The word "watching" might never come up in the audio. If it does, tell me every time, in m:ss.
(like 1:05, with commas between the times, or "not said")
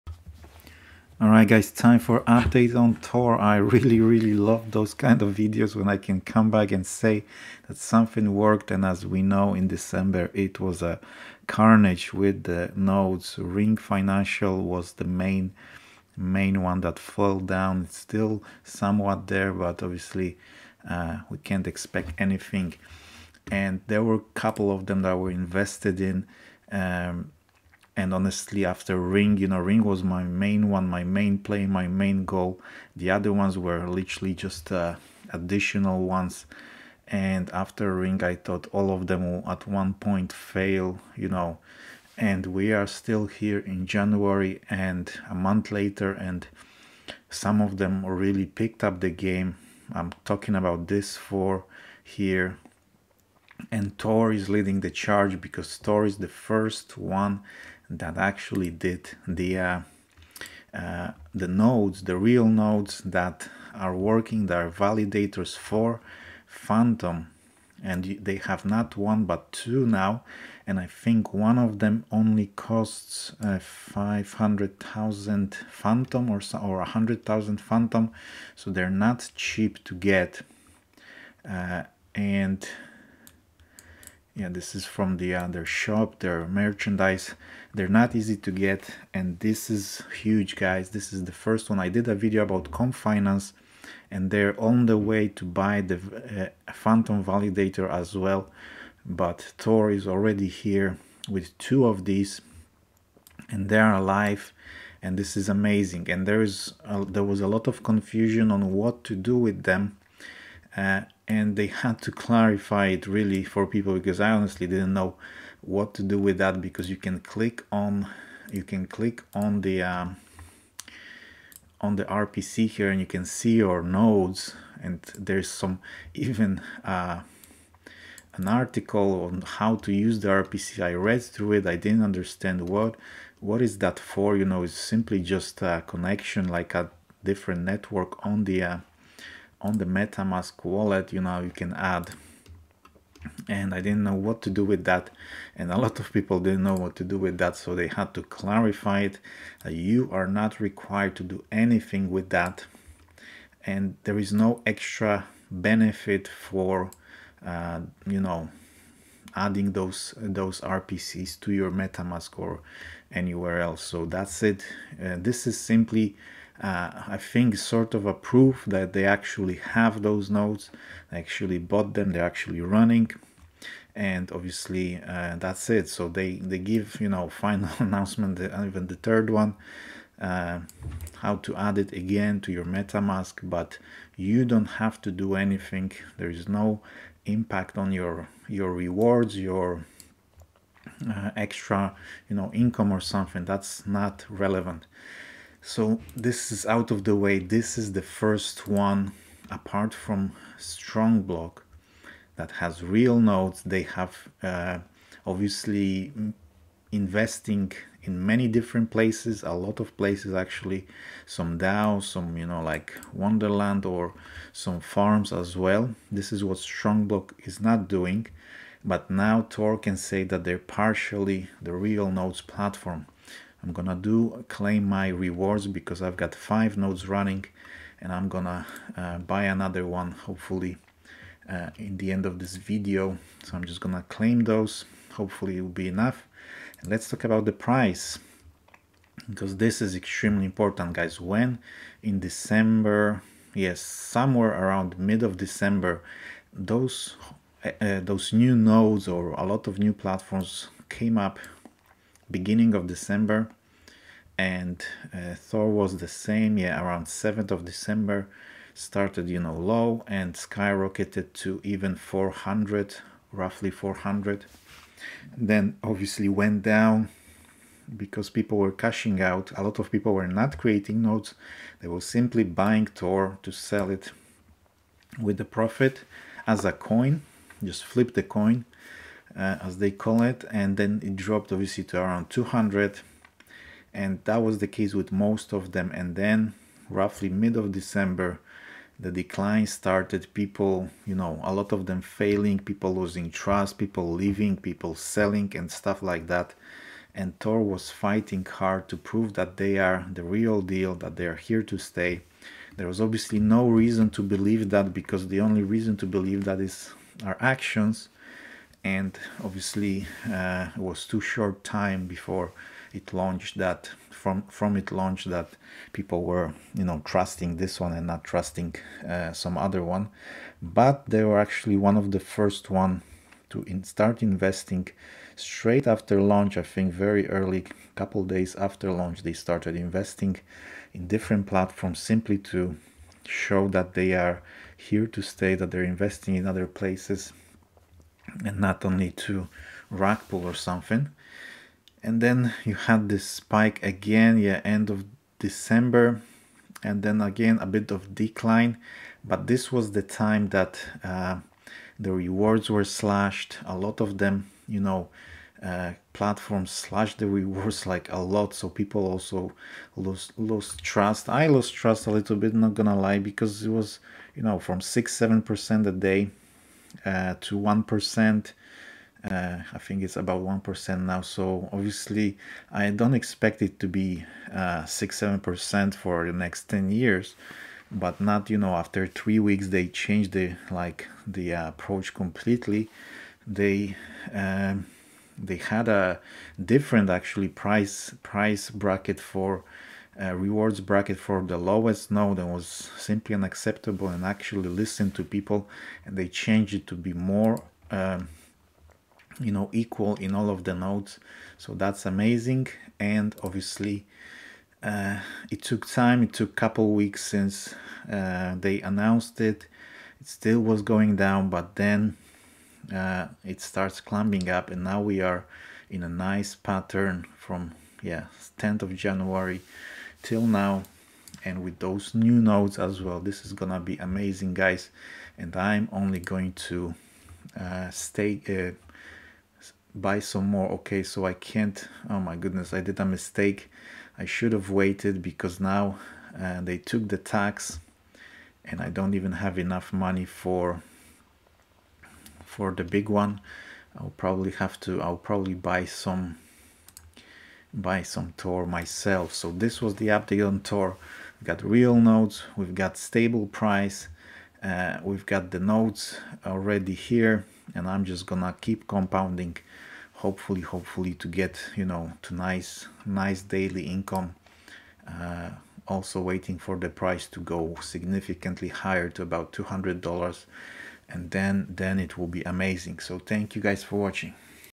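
7:53.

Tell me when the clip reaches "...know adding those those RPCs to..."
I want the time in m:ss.
2:38.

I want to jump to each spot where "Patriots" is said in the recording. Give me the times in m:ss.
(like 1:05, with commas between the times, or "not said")
not said.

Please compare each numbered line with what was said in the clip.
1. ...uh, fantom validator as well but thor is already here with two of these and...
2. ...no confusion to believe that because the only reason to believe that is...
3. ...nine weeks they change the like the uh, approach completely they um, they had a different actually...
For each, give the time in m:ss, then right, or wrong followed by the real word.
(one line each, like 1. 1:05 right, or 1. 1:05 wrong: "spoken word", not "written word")
1. 1:35 right
2. 5:03 wrong: "reason", not "confusion"
3. 6:19 wrong: "three", not "nine".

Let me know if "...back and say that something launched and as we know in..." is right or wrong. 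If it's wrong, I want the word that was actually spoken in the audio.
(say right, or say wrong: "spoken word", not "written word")
wrong: "worked", not "launched".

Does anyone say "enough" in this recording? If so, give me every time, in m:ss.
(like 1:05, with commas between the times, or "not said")
3:55, 7:19.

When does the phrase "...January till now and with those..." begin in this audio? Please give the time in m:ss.
6:58.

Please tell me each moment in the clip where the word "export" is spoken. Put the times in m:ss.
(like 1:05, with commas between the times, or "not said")
not said.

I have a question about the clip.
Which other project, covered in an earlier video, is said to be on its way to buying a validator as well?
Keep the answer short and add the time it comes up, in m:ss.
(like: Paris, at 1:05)
Comp Finance, at 1:32.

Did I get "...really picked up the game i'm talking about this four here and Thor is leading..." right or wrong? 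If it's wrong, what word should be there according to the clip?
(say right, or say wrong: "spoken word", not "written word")
right.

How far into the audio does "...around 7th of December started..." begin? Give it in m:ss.
4:16.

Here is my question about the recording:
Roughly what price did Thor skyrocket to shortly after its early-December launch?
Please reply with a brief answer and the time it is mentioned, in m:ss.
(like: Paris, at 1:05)
400, at 4:23.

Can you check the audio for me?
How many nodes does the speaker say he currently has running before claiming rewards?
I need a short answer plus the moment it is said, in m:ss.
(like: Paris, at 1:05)
5, at 3:46.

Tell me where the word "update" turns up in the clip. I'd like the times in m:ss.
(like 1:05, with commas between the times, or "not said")
0:02, 7:30.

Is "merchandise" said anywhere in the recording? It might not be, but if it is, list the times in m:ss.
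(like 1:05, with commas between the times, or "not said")
1:26.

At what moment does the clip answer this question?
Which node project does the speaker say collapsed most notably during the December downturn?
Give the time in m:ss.
0:13.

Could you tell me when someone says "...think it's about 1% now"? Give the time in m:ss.
6:09.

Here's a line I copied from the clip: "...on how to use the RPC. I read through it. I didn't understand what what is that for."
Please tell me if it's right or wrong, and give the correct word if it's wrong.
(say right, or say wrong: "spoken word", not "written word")
right.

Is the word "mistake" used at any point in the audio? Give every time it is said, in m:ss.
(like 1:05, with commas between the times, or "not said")
7:13.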